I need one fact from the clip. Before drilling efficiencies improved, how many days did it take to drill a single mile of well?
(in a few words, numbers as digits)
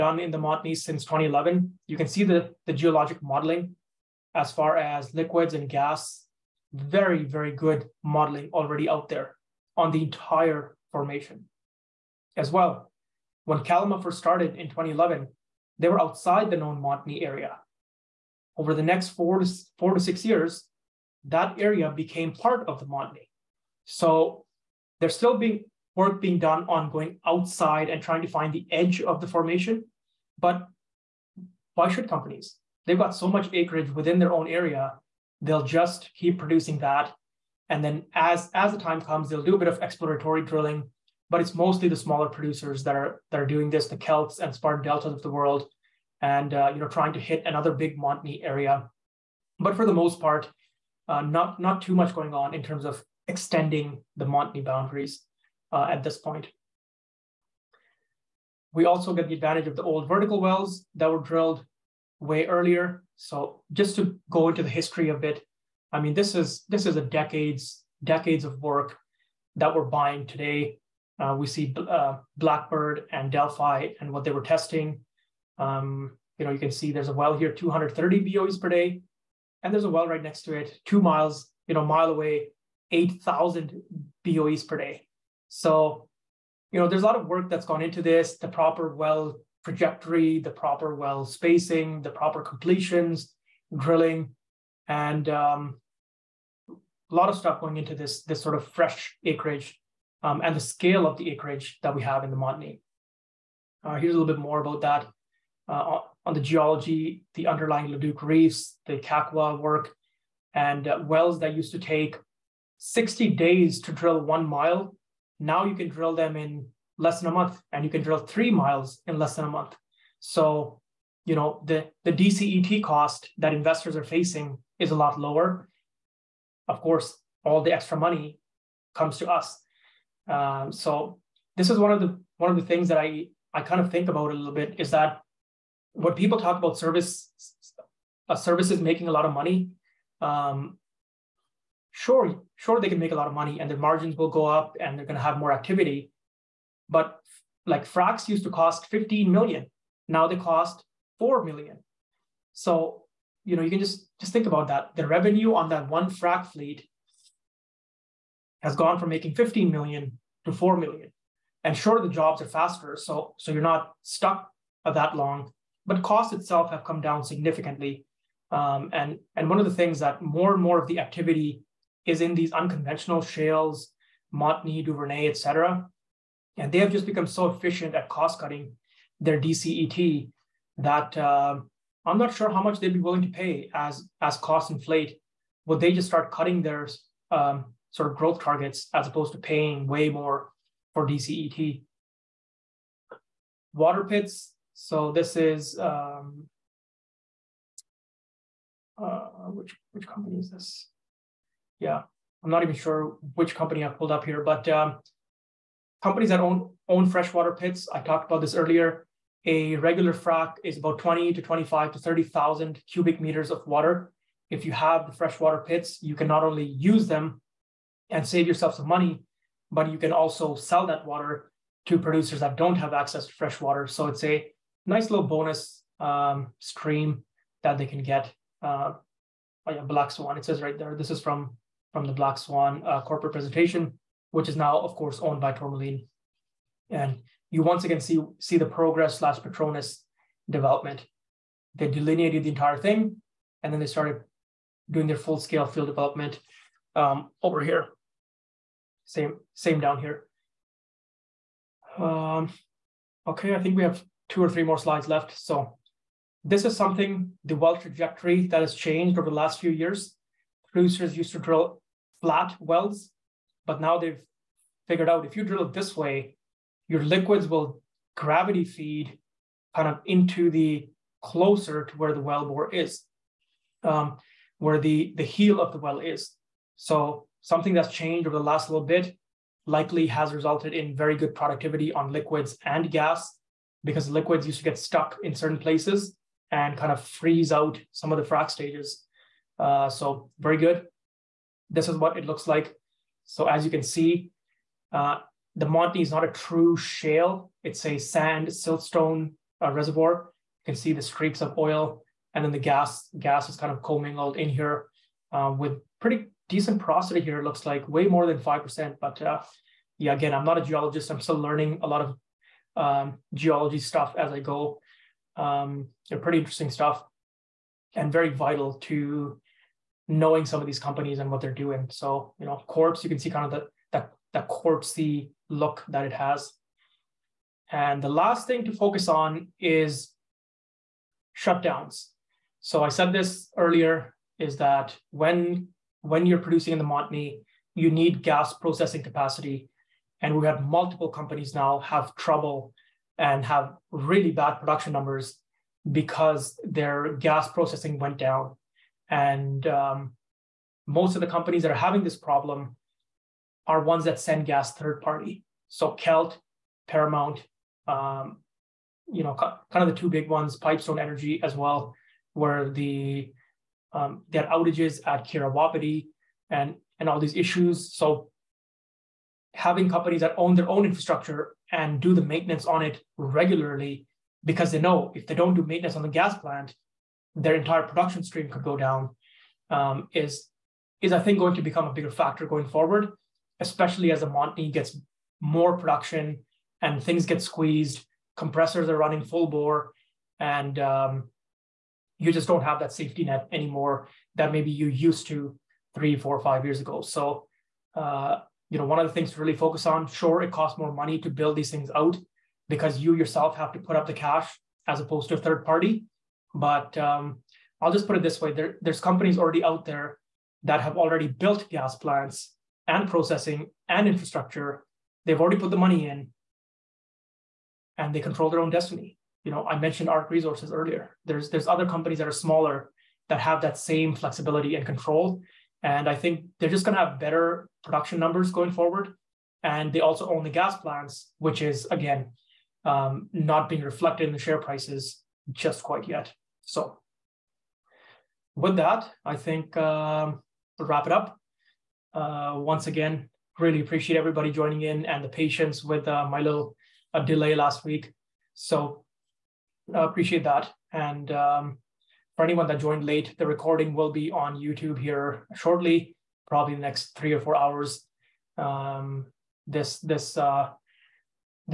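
60 days.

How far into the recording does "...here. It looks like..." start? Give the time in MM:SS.
05:07.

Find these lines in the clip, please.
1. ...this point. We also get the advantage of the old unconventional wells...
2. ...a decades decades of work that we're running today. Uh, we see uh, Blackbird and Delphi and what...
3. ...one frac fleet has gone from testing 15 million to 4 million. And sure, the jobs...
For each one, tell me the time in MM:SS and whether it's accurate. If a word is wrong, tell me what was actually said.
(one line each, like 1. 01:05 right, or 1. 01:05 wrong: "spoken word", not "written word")
1. 00:56 wrong: "vertical", not "unconventional"
2. 01:06 wrong: "buying", not "running"
3. 02:35 wrong: "making", not "testing".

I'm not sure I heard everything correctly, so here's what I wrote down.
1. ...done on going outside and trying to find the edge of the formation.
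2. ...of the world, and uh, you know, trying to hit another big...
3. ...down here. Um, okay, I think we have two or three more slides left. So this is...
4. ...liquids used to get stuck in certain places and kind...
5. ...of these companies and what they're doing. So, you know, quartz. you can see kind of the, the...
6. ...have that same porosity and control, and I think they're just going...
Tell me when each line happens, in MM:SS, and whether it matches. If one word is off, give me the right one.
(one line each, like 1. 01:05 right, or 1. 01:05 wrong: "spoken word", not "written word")
1. 00:26 right
2. 00:45 right
3. 04:09 right
4. 04:44 right
5. 05:20 right
6. 07:03 wrong: "flexibility", not "porosity".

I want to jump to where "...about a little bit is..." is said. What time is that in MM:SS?
02:14.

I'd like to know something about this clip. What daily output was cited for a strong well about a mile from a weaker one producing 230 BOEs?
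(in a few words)
8,000 BOEs per day.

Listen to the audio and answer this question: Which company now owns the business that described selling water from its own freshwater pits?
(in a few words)
Tourmaline.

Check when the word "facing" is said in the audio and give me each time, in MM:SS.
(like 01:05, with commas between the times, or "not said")
02:04.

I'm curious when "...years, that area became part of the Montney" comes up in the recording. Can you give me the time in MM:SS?
00:20.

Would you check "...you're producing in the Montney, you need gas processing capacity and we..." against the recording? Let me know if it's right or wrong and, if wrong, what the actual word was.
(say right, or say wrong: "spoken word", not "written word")
right.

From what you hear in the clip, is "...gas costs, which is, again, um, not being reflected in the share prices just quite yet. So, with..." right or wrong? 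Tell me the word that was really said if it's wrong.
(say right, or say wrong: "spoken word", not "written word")
wrong: "plants", not "costs".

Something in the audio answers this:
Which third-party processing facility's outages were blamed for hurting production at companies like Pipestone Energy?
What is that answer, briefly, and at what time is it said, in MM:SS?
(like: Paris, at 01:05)
Keyera Wapiti, at 06:05.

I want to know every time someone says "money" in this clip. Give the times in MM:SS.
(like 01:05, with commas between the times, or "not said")
02:07, 02:19, 02:23, 03:38, 06:40, 06:55.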